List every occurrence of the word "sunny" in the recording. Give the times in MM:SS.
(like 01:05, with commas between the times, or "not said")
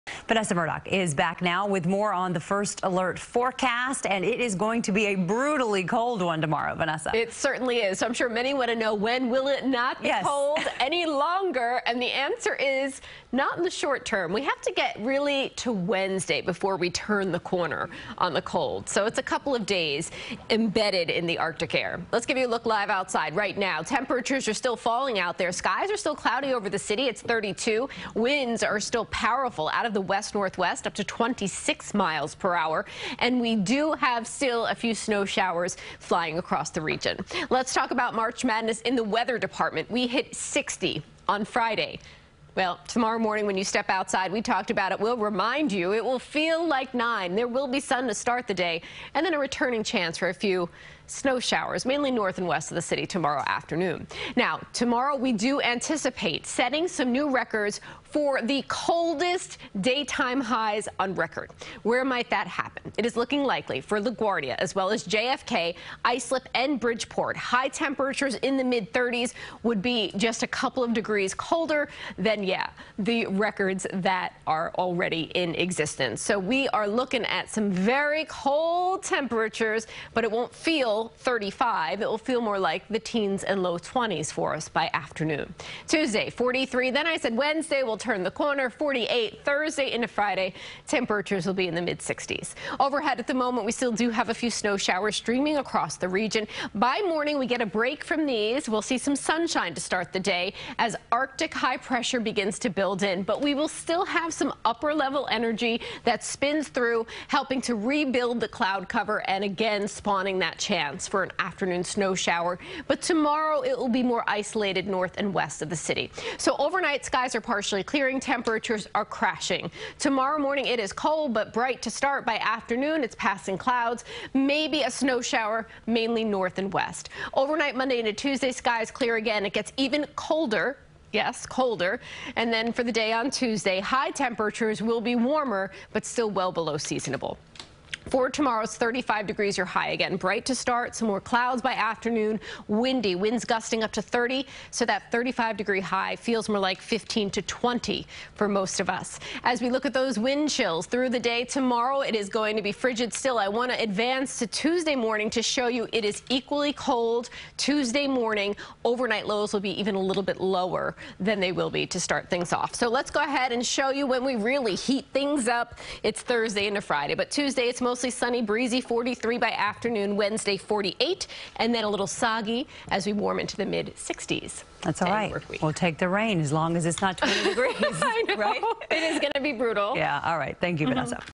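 02:48.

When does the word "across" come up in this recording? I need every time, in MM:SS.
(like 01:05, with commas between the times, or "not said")
00:36, 01:35.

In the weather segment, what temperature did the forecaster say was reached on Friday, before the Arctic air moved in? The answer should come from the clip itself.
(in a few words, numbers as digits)
60.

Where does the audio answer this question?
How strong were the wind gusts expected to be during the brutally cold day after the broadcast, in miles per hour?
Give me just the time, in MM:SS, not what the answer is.
02:23.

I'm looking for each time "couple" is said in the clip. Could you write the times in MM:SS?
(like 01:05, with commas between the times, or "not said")
00:19, 01:10.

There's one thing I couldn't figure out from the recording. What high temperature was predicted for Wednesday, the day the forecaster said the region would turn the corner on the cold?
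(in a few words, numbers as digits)
48.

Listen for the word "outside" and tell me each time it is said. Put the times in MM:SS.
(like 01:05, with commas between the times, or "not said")
00:22, 00:43.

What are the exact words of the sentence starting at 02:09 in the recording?
It gets even colder yes, colder.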